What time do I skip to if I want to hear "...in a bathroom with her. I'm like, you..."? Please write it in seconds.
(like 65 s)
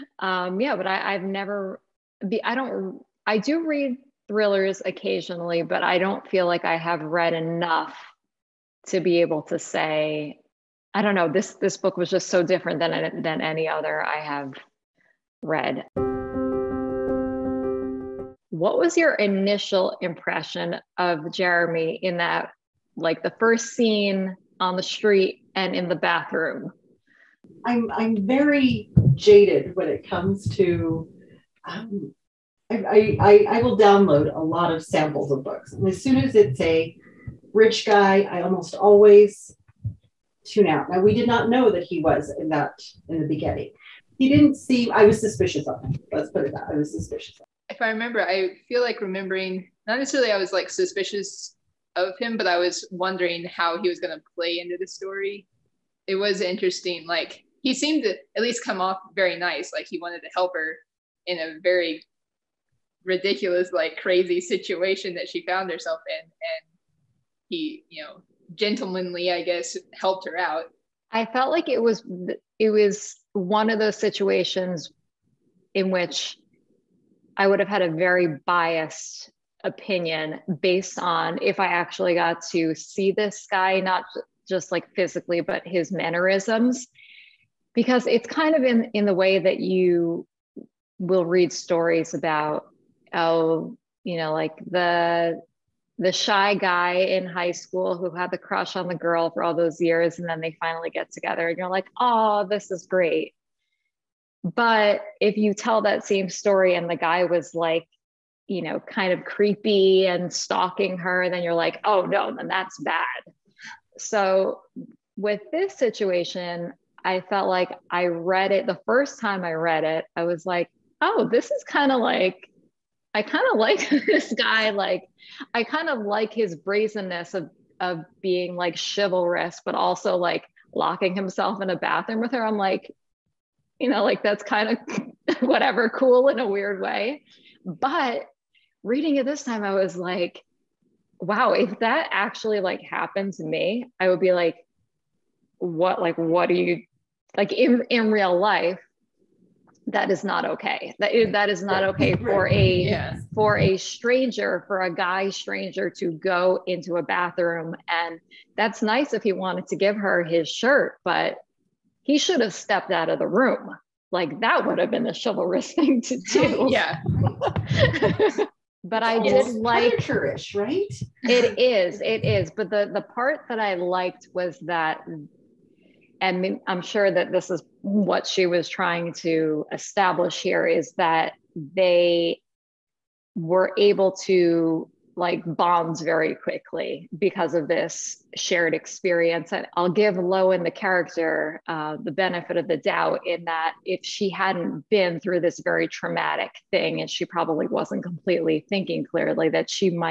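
131 s.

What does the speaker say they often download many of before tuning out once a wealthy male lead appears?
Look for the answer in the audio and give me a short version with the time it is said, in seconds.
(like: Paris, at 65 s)
Samples of books, at 34 s.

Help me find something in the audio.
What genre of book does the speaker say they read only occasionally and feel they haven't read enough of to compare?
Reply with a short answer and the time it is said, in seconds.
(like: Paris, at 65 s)
Thrillers, at 4 s.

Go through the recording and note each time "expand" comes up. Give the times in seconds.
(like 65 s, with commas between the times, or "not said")
not said.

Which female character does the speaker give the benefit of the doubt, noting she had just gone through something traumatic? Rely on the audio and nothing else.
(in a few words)
Lowen.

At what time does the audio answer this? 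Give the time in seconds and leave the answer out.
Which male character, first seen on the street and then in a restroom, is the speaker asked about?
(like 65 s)
21 s.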